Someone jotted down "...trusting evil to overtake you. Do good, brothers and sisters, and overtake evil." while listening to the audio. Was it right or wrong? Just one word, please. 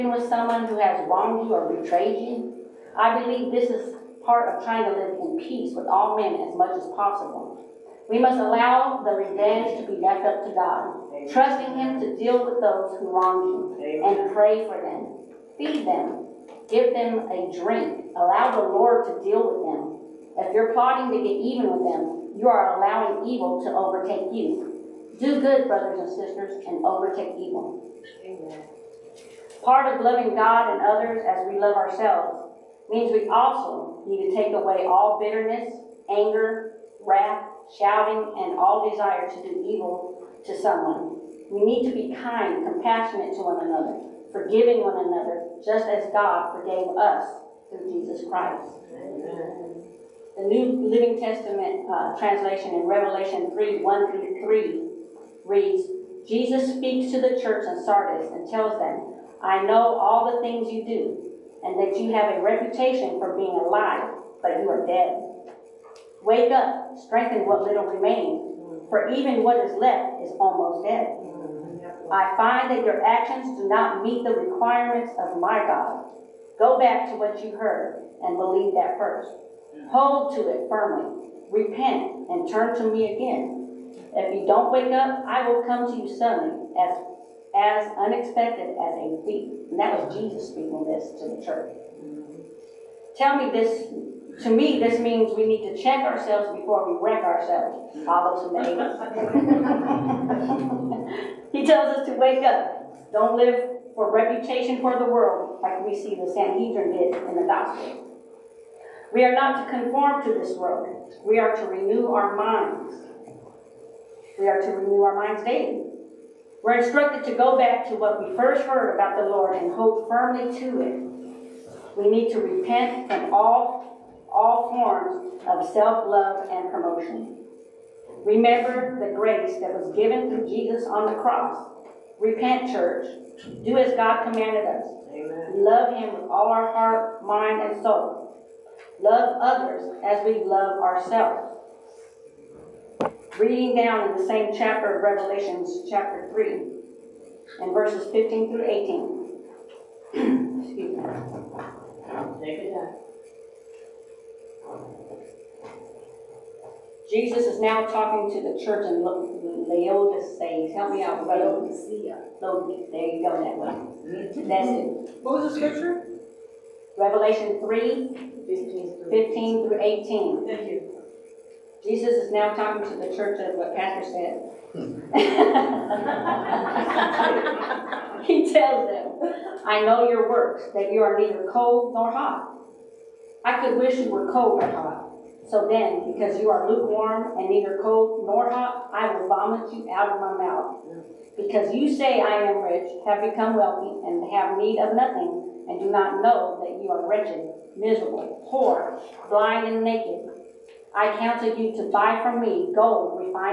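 wrong.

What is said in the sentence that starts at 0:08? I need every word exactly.
We must allow the revenge to be left up to God, Amen.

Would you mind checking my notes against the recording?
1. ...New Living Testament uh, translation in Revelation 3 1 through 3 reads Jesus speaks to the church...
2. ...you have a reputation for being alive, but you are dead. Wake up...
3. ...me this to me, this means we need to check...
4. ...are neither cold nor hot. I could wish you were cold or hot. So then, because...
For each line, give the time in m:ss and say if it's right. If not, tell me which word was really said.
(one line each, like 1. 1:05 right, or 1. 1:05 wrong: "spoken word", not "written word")
1. 0:50 right
2. 1:01 right
3. 1:33 right
4. 3:01 right.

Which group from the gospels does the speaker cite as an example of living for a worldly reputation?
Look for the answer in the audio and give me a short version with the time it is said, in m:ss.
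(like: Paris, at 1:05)
the Sanhedrin, at 1:46.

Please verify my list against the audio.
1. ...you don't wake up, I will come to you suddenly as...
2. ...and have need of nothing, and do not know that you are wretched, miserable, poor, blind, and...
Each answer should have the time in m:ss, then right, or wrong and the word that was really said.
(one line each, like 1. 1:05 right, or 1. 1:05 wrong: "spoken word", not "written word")
1. 1:24 right
2. 3:14 right.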